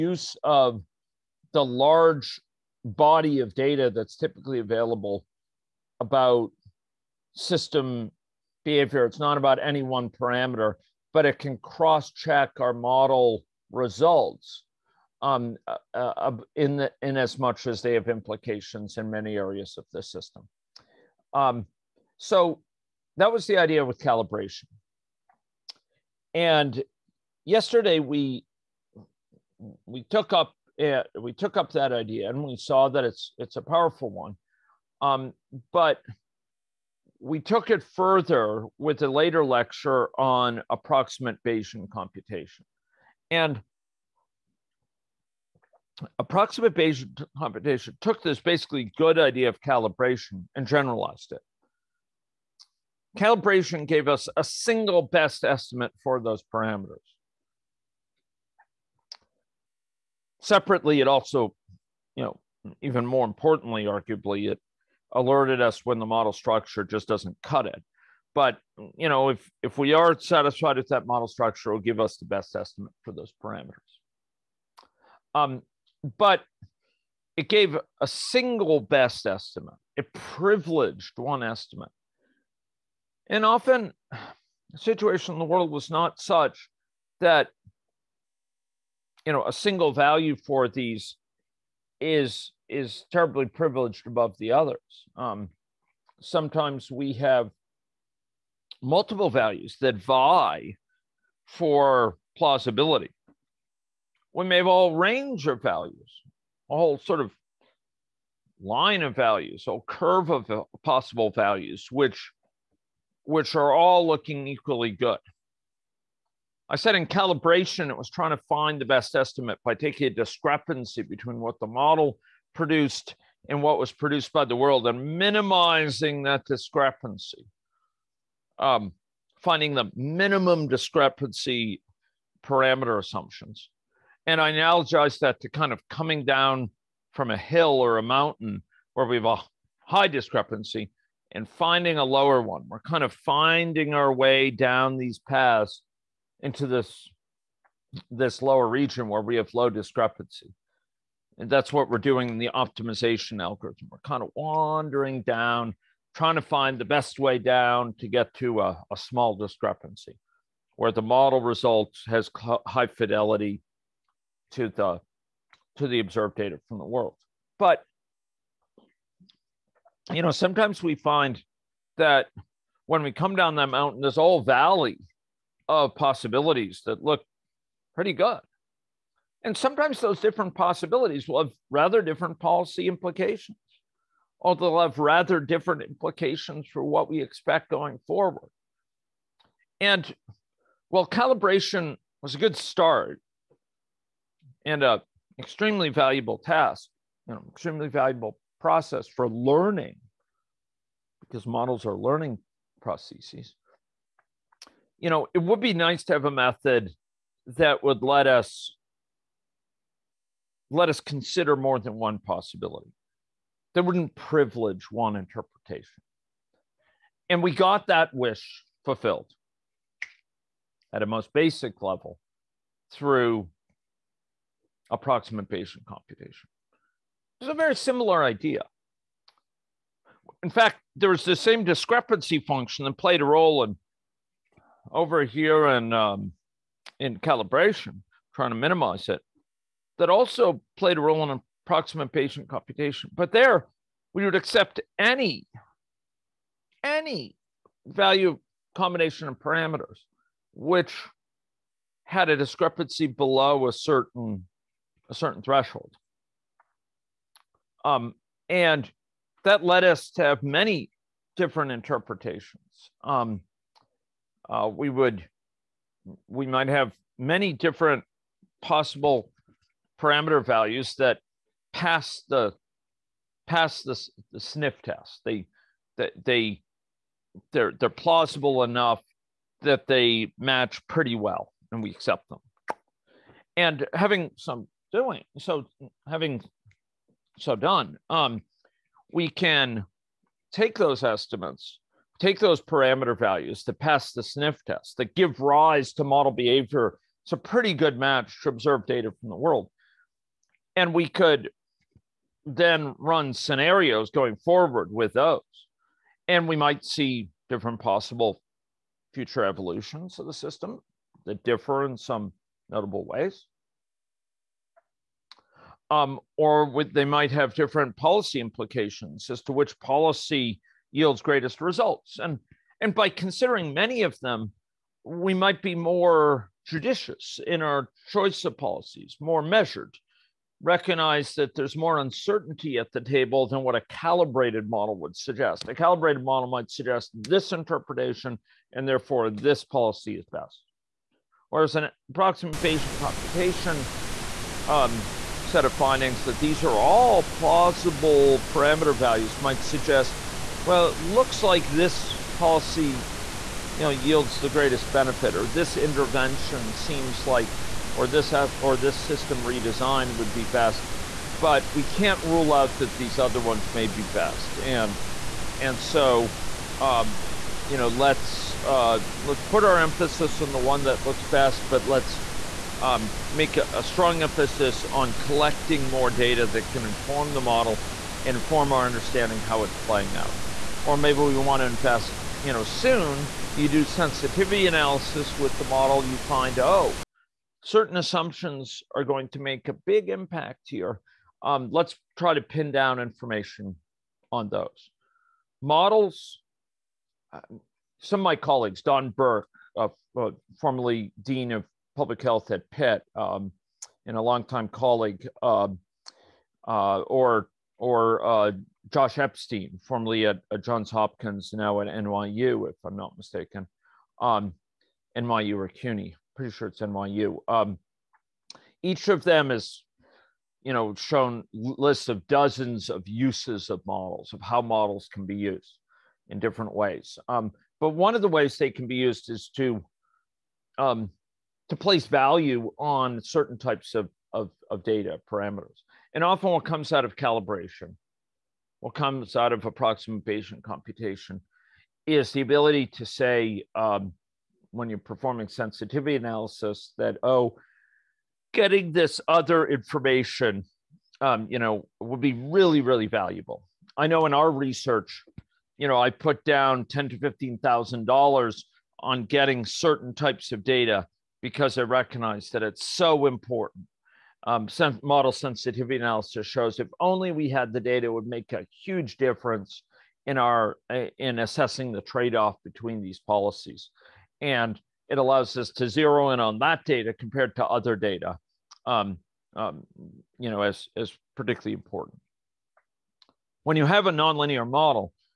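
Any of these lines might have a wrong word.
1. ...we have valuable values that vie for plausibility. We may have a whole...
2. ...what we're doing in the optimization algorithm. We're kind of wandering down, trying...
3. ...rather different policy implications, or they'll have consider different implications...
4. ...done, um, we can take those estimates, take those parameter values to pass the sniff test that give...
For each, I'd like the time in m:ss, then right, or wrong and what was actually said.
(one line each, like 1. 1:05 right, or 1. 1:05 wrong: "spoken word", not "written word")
1. 1:36 wrong: "multiple", not "valuable"
2. 2:31 right
3. 3:01 wrong: "rather", not "consider"
4. 4:47 right.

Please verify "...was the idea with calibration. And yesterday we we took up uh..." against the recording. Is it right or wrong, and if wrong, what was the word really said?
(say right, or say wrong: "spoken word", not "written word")
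right.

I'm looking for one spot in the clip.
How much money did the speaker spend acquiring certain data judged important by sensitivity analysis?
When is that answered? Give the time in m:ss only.
7:36.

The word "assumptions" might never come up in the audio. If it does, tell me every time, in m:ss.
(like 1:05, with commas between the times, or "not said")
2:12, 6:27.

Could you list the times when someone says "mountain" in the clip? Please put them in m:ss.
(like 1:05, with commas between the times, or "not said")
2:18, 2:53.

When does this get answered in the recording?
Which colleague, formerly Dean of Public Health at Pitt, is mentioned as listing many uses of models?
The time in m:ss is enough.
6:38.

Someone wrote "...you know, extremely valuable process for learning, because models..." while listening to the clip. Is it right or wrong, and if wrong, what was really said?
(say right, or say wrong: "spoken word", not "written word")
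right.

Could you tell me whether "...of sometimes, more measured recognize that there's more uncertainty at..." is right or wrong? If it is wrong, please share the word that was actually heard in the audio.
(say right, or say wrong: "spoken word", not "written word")
wrong: "policies", not "sometimes".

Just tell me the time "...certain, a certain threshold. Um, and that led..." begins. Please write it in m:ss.
4:13.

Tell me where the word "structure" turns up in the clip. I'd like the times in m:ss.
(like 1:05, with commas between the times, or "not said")
1:06, 1:11.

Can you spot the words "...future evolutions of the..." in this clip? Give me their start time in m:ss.
5:09.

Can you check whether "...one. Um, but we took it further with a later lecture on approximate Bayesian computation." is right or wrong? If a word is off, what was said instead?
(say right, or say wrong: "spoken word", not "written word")
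right.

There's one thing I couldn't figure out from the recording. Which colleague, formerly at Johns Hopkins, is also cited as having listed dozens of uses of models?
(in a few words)
Josh Epstein.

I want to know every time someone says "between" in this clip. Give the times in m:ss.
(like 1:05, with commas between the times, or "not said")
2:01, 7:52.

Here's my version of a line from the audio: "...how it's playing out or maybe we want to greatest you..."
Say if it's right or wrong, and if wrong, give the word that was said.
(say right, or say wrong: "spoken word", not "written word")
wrong: "invest", not "greatest".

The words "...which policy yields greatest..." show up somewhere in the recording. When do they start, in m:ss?
5:19.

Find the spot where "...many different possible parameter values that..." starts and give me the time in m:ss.
4:27.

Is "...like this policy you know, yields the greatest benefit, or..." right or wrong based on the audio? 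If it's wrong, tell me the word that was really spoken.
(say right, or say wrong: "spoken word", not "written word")
right.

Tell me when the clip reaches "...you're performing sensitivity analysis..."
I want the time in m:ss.
7:24.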